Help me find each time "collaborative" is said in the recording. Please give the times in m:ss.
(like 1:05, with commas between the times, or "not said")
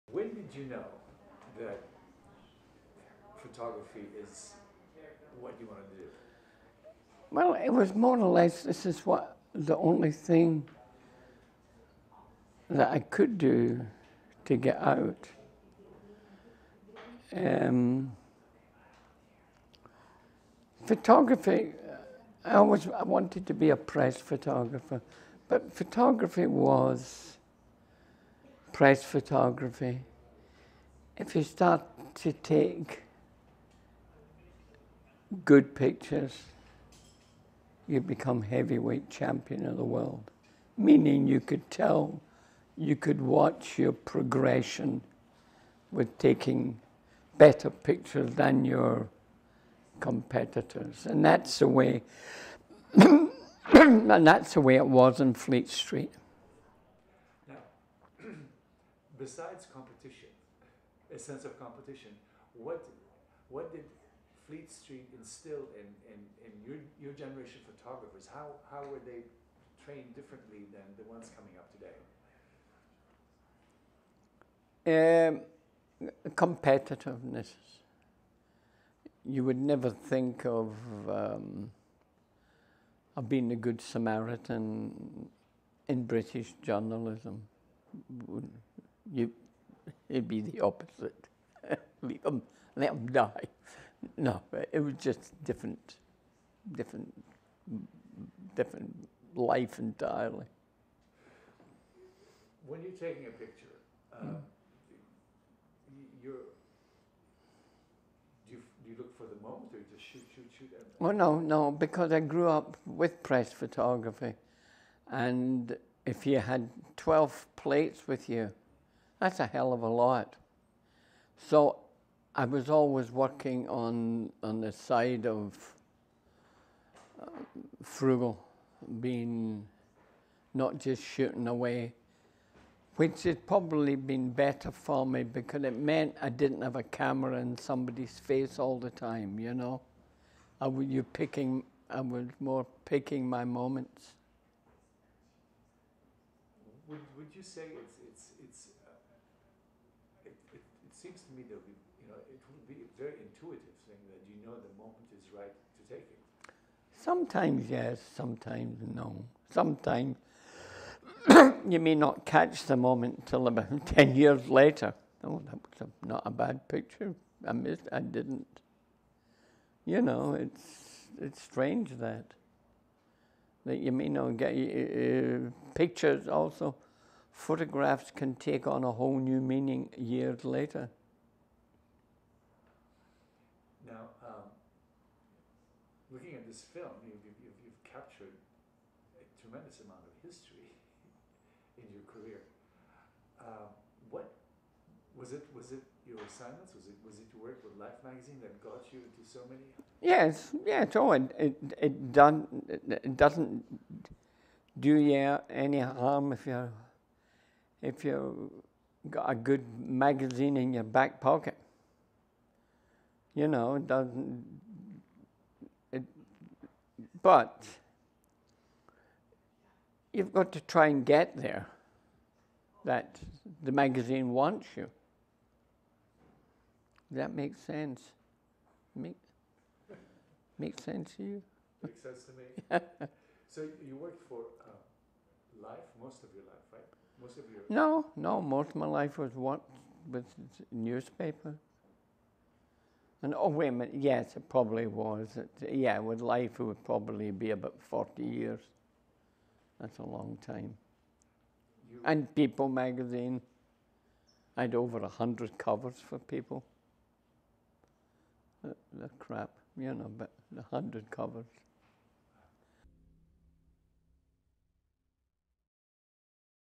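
not said.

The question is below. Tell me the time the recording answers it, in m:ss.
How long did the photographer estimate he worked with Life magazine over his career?
4:07.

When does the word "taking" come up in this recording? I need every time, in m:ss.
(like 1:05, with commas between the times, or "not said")
0:46, 1:42.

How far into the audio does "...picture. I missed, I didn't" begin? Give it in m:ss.
2:46.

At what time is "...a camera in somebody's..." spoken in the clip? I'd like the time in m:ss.
2:16.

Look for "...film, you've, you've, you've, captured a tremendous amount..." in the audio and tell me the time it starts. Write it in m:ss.
3:06.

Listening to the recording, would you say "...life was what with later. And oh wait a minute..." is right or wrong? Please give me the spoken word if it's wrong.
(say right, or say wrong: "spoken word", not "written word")
wrong: "newspaper", not "later".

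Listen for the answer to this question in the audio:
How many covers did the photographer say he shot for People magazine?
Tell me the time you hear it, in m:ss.
4:14.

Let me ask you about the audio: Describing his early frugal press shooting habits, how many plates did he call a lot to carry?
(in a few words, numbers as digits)
12.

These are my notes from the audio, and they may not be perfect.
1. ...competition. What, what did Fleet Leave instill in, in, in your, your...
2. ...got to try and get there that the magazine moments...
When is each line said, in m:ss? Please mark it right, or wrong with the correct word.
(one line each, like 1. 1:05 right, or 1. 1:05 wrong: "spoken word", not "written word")
1. 1:01 wrong: "Street", not "Leave"
2. 3:40 wrong: "wants", not "moments".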